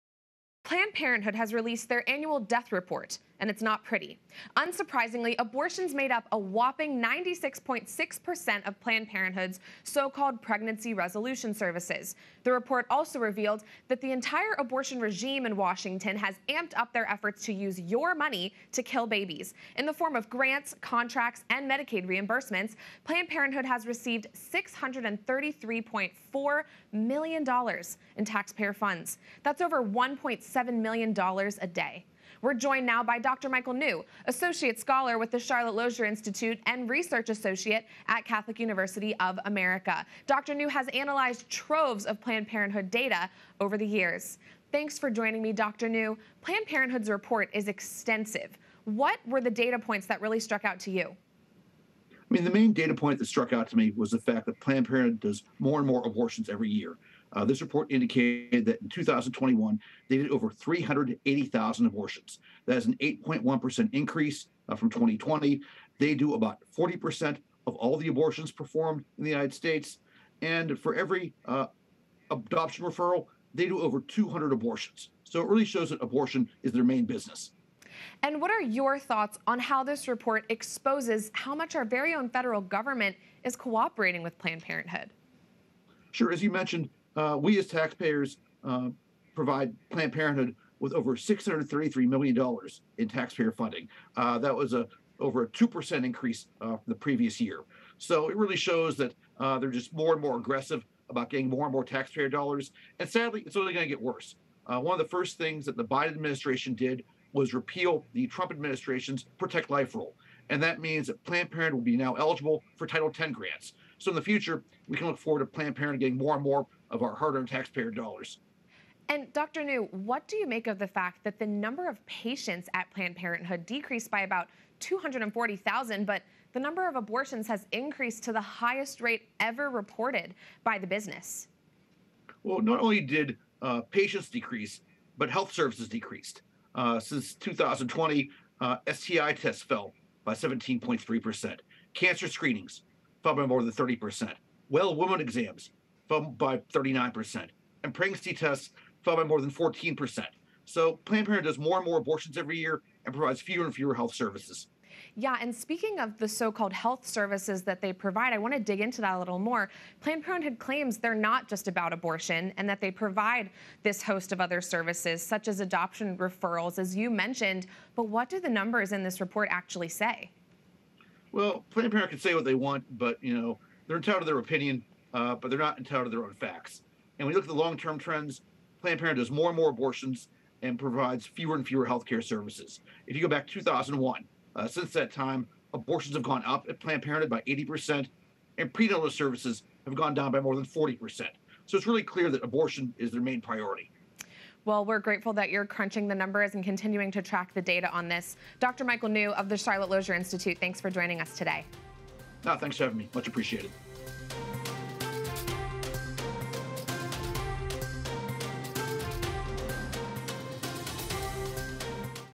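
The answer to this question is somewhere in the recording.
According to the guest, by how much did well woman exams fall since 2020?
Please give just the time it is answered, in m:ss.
2:26.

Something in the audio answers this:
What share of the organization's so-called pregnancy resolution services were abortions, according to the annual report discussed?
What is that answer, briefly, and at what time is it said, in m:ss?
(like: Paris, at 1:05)
96.6%, at 0:07.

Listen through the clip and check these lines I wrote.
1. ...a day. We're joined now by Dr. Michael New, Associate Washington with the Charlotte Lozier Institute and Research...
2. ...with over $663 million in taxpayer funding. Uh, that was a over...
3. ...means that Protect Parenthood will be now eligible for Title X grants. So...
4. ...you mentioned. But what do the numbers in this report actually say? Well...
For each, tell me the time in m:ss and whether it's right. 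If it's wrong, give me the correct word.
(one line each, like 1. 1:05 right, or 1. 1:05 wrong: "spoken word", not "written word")
1. 0:31 wrong: "Scholar", not "Washington"
2. 1:30 wrong: "633", not "663"
3. 1:50 wrong: "Planned", not "Protect"
4. 2:46 right.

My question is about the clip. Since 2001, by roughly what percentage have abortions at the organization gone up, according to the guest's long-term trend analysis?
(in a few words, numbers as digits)
80%.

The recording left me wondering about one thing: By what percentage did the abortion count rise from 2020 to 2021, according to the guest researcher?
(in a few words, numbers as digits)
8.1%.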